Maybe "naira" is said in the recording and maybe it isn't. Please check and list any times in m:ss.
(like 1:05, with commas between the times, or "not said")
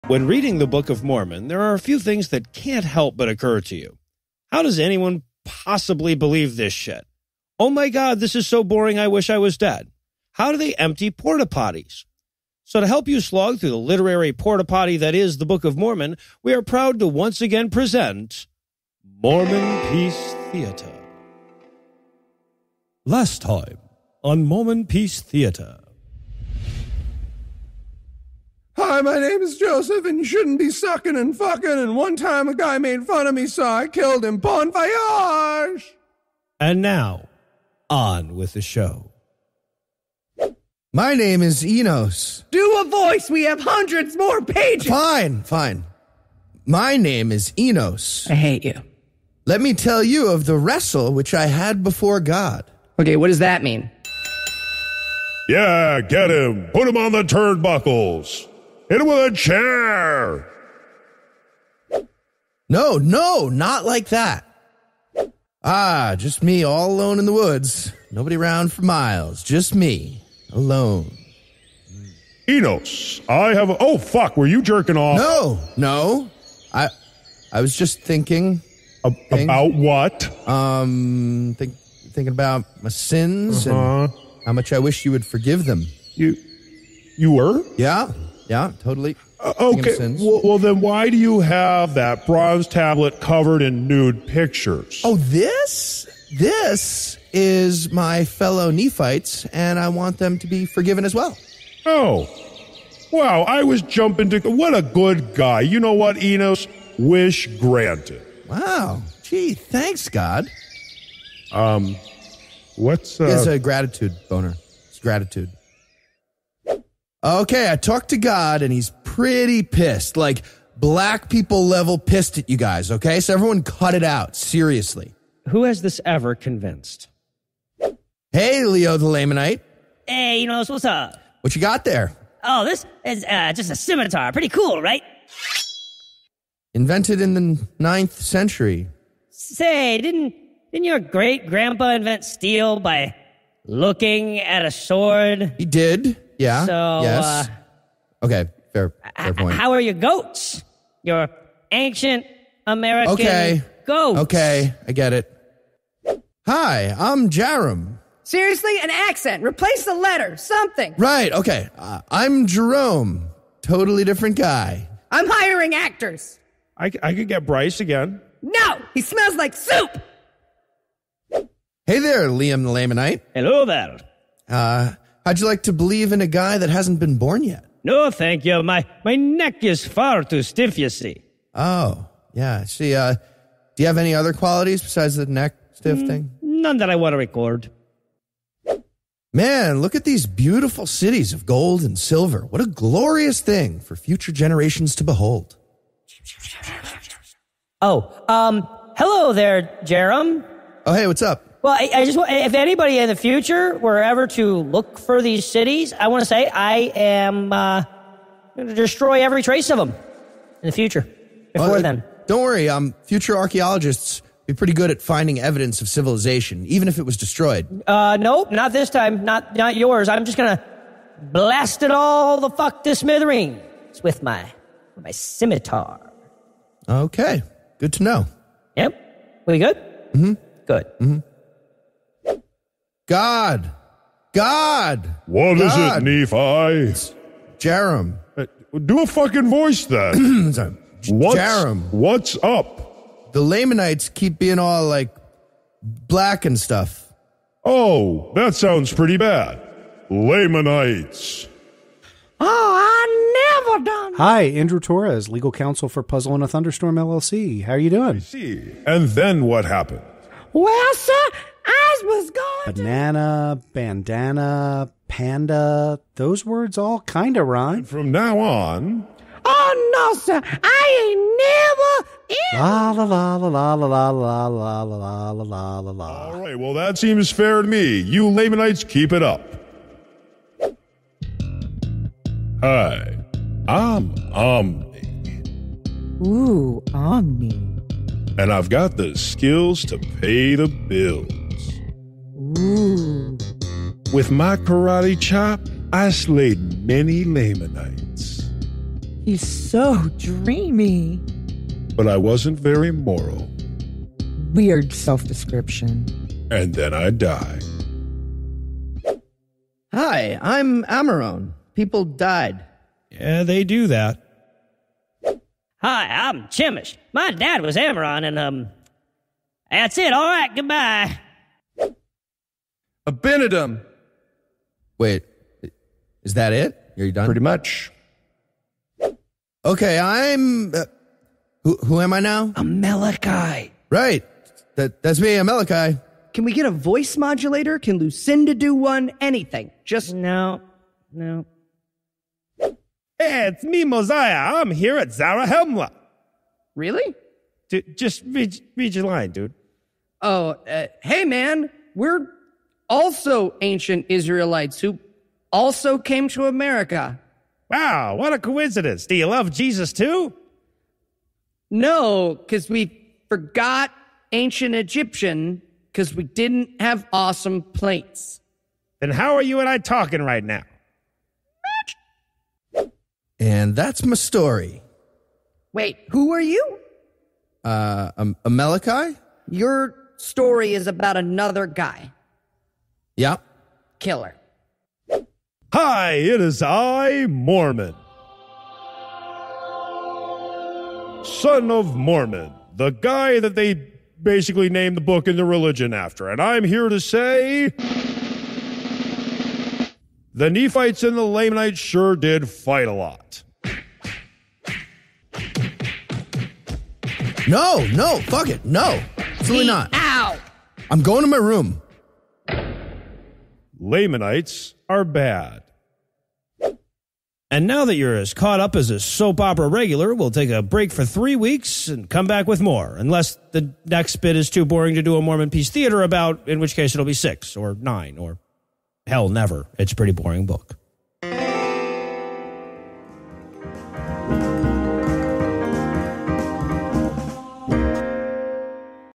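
not said.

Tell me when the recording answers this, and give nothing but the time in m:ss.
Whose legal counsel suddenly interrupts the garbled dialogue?
4:16.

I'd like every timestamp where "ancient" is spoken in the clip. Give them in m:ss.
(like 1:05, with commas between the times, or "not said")
2:31, 5:53, 6:04.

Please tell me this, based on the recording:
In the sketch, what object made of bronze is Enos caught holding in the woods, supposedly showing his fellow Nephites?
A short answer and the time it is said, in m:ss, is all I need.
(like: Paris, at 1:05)
tablet, at 1:32.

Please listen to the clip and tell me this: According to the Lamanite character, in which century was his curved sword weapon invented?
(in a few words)
ninth century.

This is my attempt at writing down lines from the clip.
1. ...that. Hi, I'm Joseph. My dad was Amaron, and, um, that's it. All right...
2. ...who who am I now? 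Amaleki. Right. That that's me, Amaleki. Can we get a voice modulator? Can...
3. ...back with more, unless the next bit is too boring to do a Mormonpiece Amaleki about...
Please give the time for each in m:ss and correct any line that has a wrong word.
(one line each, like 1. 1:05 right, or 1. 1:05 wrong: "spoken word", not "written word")
1. 5:13 wrong: "Chemish", not "Joseph"
2. 5:31 right
3. 7:02 wrong: "Theater", not "Amaleki".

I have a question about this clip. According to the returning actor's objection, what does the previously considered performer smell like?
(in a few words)
soup.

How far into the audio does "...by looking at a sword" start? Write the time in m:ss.
2:22.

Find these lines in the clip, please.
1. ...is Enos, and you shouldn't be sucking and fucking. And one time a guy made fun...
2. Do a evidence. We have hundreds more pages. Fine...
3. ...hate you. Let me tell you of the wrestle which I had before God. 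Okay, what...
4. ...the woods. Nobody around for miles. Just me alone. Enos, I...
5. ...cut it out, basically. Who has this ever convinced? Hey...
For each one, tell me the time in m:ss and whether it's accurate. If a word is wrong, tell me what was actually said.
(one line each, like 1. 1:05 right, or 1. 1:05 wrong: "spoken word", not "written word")
1. 0:29 wrong: "Joseph", not "Enos"
2. 0:42 wrong: "voice", not "evidence"
3. 0:48 right
4. 1:07 right
5. 2:03 wrong: "seriously", not "basically".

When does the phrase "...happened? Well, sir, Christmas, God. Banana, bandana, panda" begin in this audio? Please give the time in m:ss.
4:19.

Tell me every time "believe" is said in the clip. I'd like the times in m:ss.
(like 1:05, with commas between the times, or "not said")
0:06, 2:55.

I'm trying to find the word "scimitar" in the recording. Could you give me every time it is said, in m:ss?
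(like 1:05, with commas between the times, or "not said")
2:13, 3:45.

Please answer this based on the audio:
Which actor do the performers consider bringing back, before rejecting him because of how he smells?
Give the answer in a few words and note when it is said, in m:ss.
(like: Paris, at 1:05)
Bryce, at 2:47.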